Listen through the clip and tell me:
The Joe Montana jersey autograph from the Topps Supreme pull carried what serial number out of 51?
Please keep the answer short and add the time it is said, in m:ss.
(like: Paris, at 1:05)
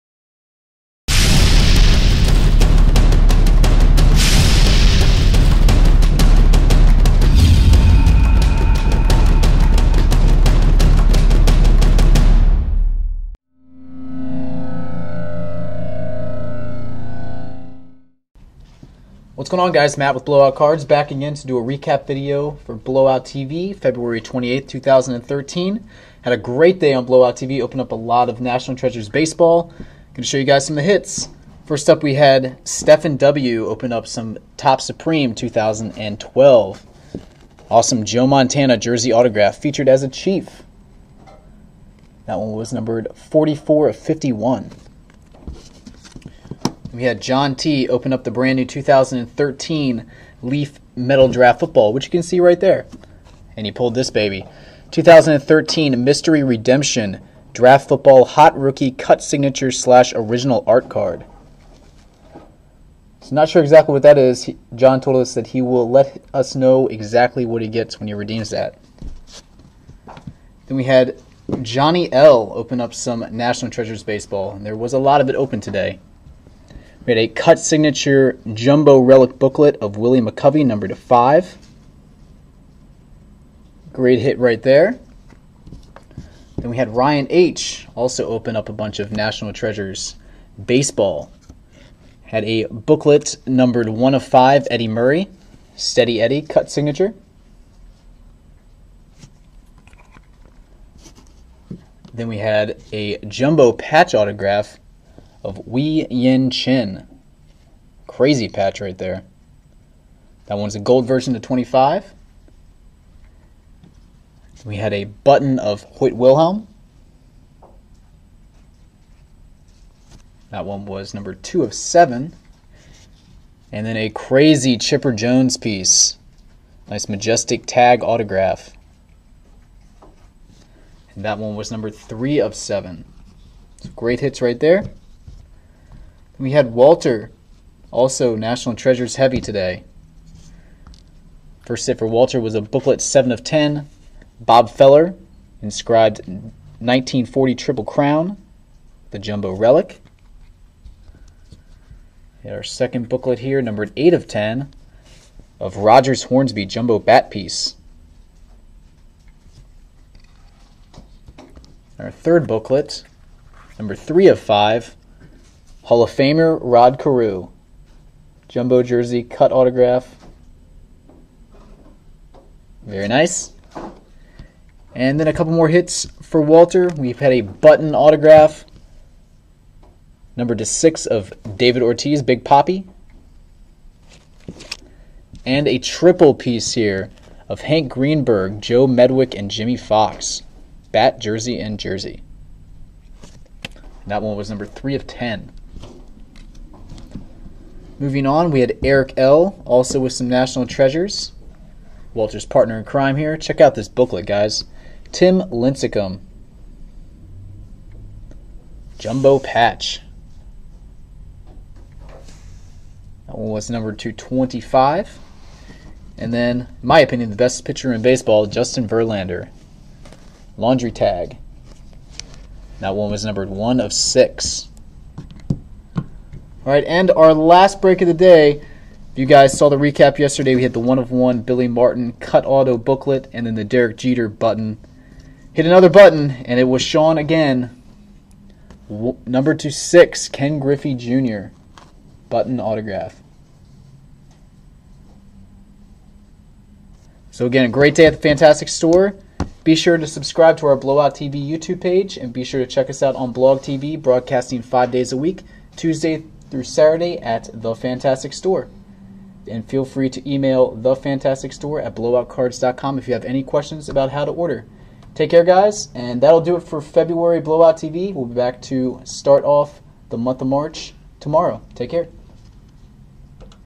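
44, at 0:43.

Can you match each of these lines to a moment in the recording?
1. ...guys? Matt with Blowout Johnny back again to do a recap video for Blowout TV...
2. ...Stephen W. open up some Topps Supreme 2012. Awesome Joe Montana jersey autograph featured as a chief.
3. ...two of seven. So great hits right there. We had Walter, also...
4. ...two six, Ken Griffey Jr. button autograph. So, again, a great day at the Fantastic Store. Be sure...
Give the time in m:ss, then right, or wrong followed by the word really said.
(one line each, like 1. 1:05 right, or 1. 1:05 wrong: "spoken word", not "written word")
1. 0:19 wrong: "Cards", not "Johnny"
2. 0:32 right
3. 2:11 wrong: "three", not "two"
4. 3:59 right.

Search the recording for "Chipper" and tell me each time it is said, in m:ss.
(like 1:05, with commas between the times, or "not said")
2:04.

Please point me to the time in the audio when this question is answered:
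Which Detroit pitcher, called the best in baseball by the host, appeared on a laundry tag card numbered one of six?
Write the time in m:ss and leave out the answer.
3:38.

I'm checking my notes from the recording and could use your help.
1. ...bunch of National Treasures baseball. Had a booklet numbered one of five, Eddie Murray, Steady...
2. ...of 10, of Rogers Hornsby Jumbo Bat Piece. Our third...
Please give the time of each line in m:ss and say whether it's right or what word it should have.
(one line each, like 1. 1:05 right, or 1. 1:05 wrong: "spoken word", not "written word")
1. 1:28 right
2. 2:34 right.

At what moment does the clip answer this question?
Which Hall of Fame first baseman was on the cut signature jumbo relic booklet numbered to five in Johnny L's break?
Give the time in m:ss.
1:19.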